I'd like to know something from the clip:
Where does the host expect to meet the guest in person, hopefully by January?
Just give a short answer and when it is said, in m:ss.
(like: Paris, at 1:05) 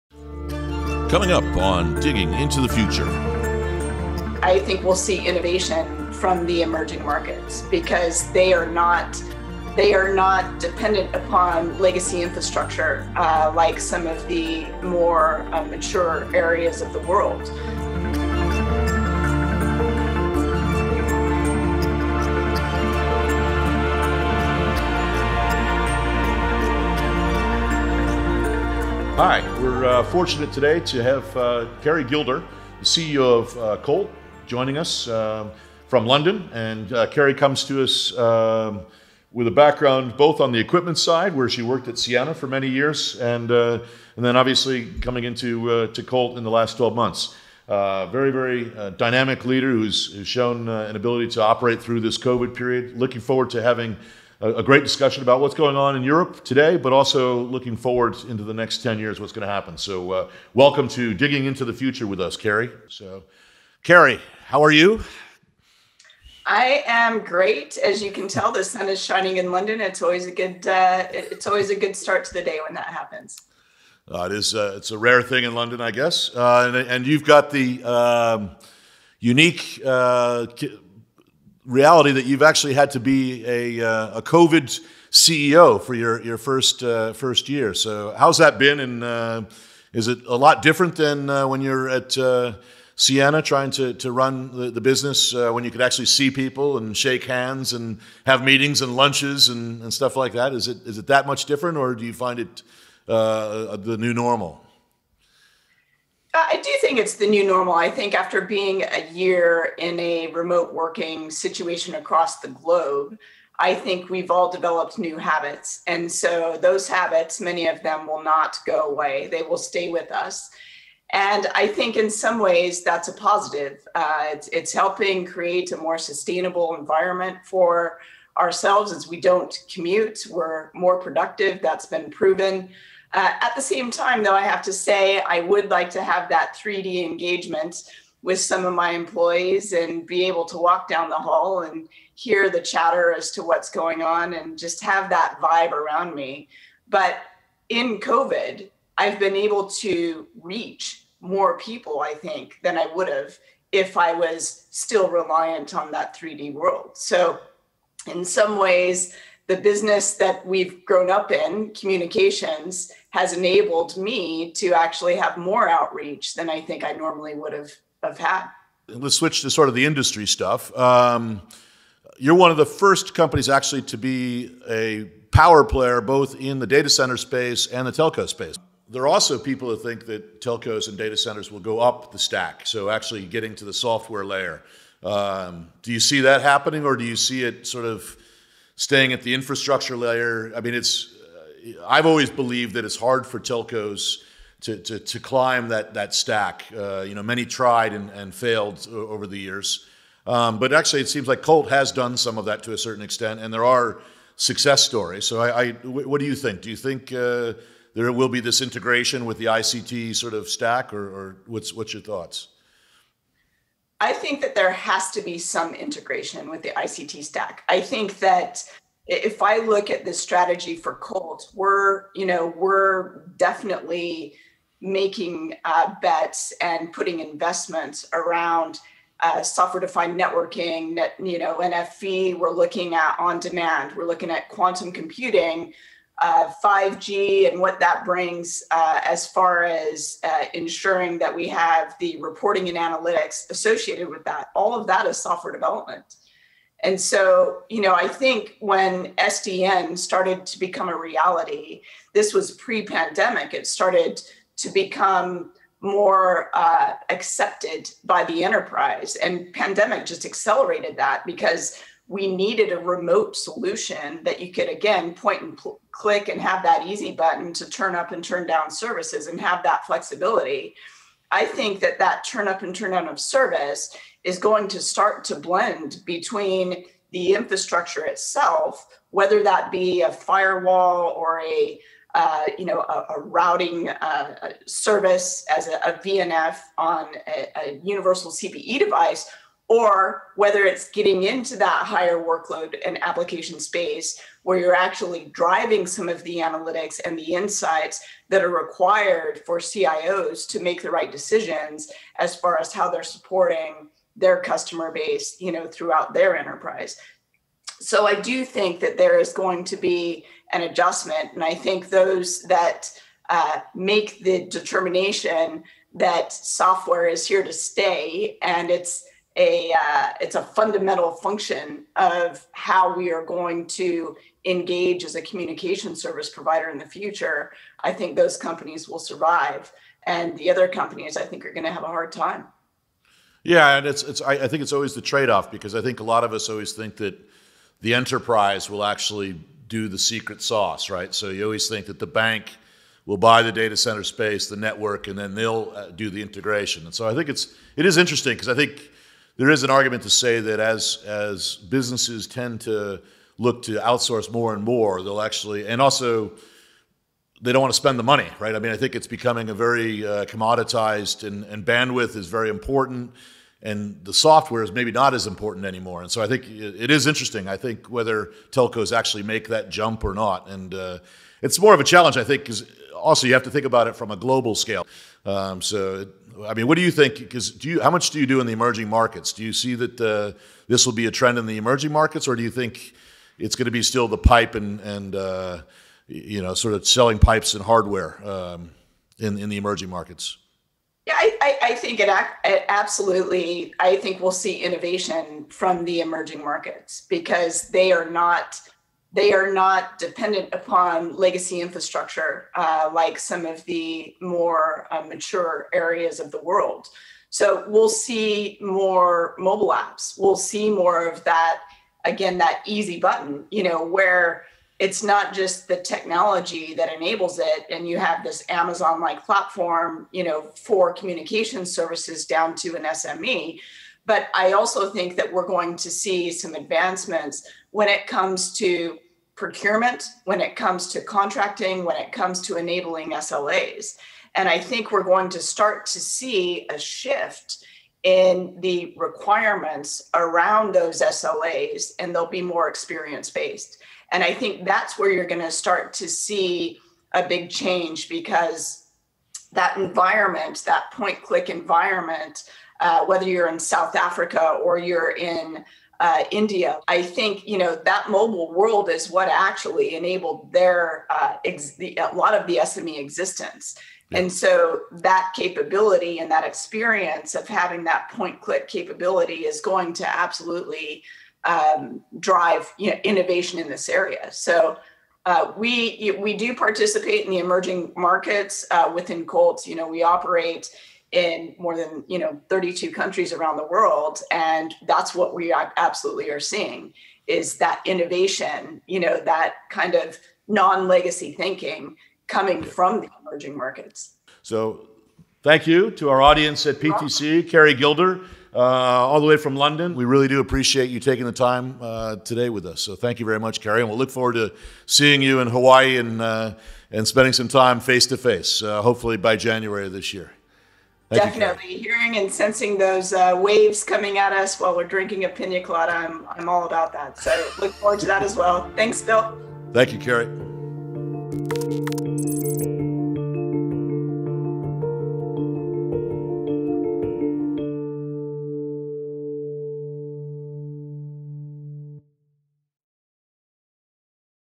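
Hawaii, at 8:25.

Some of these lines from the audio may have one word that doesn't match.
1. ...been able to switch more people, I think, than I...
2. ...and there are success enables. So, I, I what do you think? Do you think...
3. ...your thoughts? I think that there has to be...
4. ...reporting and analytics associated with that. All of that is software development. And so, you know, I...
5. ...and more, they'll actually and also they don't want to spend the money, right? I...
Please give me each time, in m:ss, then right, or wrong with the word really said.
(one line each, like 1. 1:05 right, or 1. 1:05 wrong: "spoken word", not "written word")
1. 2:29 wrong: "reach", not "switch"
2. 3:23 wrong: "stories", not "enables"
3. 3:31 right
4. 4:02 right
5. 5:54 right.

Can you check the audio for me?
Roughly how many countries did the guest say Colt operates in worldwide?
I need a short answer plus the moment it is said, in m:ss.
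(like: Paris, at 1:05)
32, at 8:02.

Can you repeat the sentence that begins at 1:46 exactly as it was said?
Uh, I do think it's the new normal.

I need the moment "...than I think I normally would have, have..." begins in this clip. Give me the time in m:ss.
2:46.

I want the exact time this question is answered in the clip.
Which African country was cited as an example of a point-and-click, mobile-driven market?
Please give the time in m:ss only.
7:33.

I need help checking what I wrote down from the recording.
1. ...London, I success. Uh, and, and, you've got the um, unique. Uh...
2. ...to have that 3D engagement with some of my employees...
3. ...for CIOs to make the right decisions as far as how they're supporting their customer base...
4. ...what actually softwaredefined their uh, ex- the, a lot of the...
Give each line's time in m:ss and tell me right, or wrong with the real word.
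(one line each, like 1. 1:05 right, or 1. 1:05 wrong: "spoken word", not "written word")
1. 1:15 wrong: "guess", not "success"
2. 2:15 right
3. 4:59 right
4. 7:39 wrong: "enabled", not "softwaredefined".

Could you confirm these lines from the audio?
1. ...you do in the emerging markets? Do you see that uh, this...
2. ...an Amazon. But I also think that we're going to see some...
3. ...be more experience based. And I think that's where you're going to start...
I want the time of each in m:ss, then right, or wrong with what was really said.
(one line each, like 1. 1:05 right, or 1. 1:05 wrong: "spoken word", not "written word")
1. 6:18 right
2. 7:02 wrong: "SME", not "Amazon"
3. 7:22 right.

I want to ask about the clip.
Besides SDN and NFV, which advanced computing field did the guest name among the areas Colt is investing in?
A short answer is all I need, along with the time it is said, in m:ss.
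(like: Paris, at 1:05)
quantum computing, at 3:54.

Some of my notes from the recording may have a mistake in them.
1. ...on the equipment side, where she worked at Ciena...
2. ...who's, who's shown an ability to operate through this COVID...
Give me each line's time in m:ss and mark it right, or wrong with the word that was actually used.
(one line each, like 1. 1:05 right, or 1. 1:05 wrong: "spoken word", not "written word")
1. 0:40 right
2. 0:49 right.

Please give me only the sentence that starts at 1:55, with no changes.
And so those habits, many of them will not go away, they will stay with us.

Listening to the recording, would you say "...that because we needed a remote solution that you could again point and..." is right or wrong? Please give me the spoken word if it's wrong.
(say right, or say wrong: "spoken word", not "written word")
right.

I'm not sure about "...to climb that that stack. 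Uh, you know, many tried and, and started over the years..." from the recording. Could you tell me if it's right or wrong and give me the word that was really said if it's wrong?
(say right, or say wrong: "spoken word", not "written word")
wrong: "failed", not "started".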